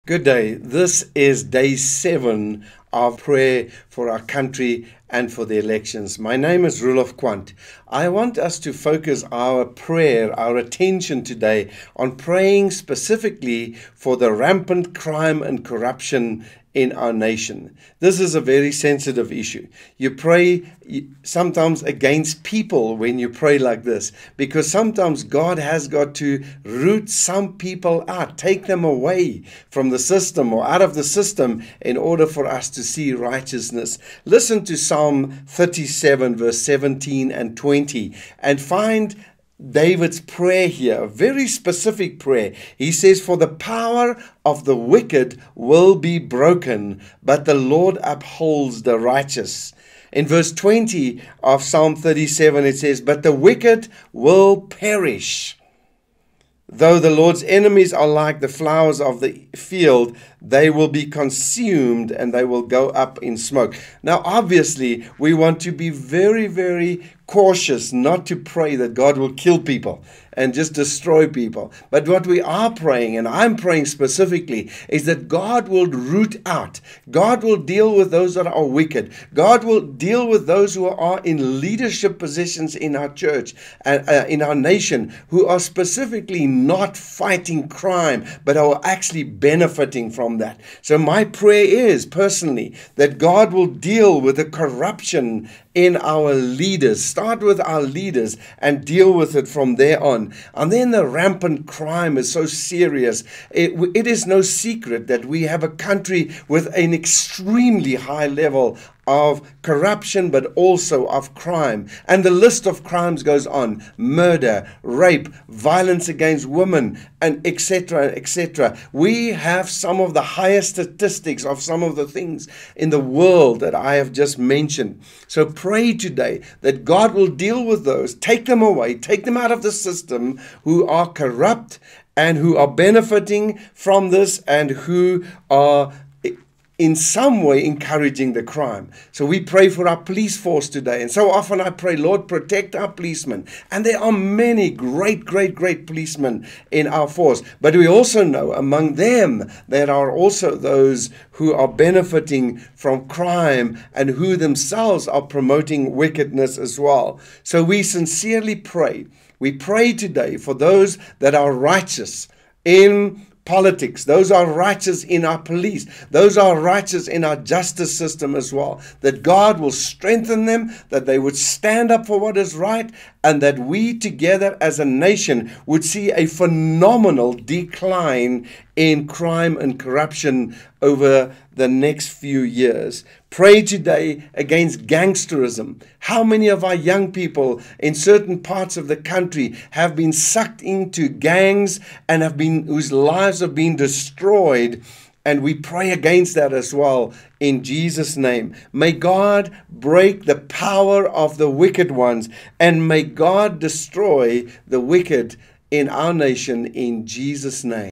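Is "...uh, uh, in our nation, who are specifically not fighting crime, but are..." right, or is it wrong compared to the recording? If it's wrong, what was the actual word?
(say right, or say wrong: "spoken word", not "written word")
right.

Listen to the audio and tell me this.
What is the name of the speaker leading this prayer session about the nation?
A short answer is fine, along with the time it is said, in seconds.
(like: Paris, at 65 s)
Roelof Quant, at 6 s.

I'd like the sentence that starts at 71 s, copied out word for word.
But what we are praying, and I'm praying specifically, is that God will root out.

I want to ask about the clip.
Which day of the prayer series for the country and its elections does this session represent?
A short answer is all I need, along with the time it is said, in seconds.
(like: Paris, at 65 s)
Day 7, at 1 s.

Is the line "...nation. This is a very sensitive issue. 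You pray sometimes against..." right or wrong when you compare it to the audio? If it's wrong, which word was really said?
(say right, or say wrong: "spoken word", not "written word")
right.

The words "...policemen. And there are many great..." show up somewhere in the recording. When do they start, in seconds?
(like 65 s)
142 s.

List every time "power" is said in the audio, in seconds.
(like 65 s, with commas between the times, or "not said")
43 s, 200 s.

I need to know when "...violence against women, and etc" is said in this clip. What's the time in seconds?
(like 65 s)
115 s.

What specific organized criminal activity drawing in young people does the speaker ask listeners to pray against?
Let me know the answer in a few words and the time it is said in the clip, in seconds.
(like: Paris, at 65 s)
Gangsterism, at 184 s.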